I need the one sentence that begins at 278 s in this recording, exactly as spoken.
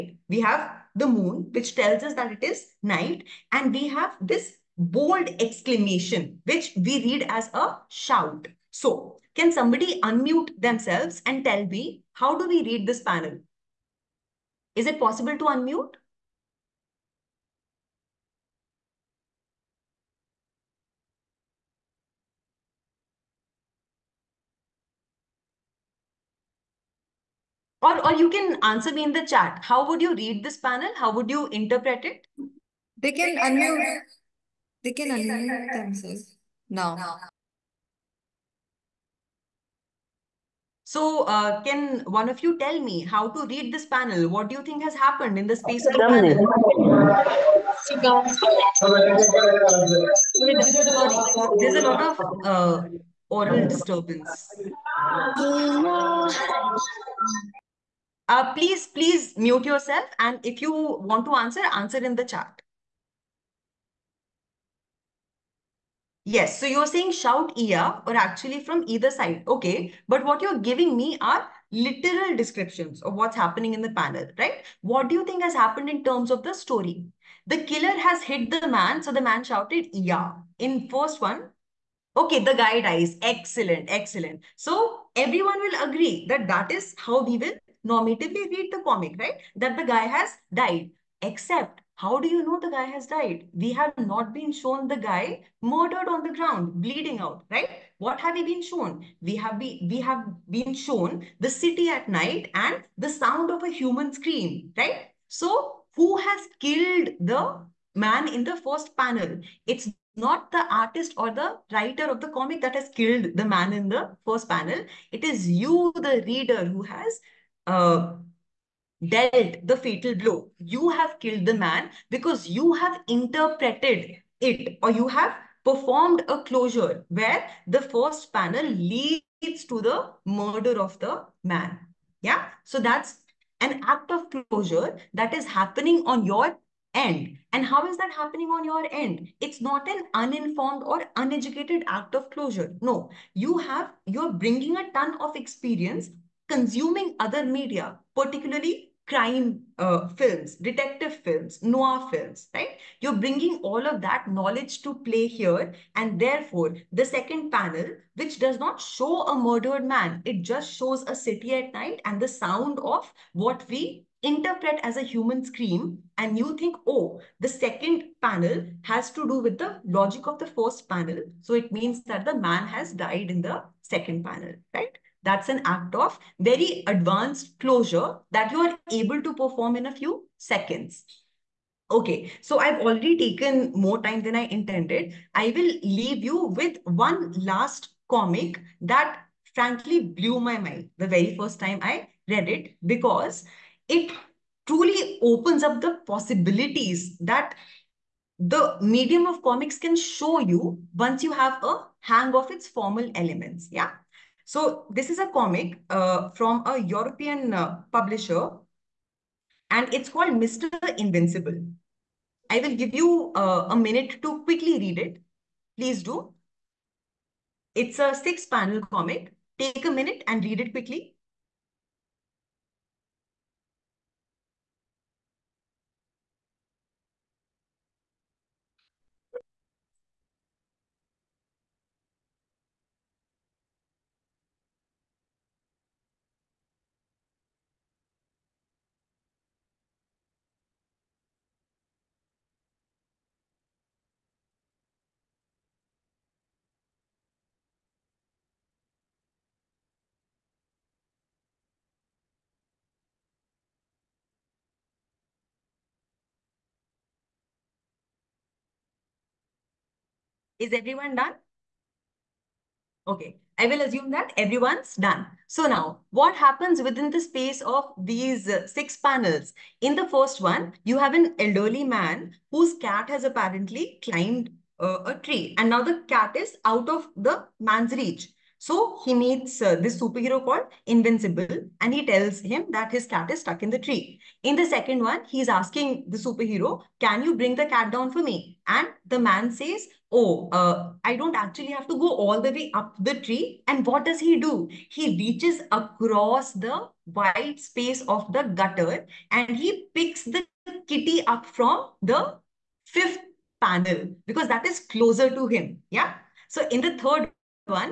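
So he meets uh, this superhero called Invincible and he tells him that his cat is stuck in the tree.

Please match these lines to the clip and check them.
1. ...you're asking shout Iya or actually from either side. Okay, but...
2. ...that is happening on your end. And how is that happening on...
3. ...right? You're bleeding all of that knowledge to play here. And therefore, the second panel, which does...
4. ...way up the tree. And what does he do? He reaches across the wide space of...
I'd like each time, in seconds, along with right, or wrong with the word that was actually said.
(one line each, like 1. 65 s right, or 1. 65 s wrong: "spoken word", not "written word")
1. 66 s wrong: "saying", not "asking"
2. 135 s right
3. 152 s wrong: "bringing", not "bleeding"
4. 292 s right.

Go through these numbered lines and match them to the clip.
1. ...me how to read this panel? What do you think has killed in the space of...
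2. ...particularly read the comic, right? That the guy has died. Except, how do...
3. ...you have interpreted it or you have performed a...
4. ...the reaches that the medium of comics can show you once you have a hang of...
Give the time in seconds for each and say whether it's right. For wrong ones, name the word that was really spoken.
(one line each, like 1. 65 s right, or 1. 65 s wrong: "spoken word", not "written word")
1. 42 s wrong: "happened", not "killed"
2. 87 s wrong: "normatively", not "particularly"
3. 122 s right
4. 195 s wrong: "possibilities", not "reaches".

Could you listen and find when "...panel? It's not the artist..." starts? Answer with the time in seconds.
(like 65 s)
108 s.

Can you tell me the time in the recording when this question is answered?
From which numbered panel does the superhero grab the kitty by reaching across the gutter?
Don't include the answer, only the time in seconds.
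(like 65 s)
302 s.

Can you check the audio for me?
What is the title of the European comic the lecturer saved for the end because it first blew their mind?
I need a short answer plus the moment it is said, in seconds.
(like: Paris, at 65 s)
Mr. Invincible, at 210 s.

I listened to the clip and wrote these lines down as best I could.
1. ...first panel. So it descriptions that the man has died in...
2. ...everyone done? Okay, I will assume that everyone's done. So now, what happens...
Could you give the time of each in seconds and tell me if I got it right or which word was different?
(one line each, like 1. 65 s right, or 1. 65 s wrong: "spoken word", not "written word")
1. 170 s wrong: "means", not "descriptions"
2. 260 s right.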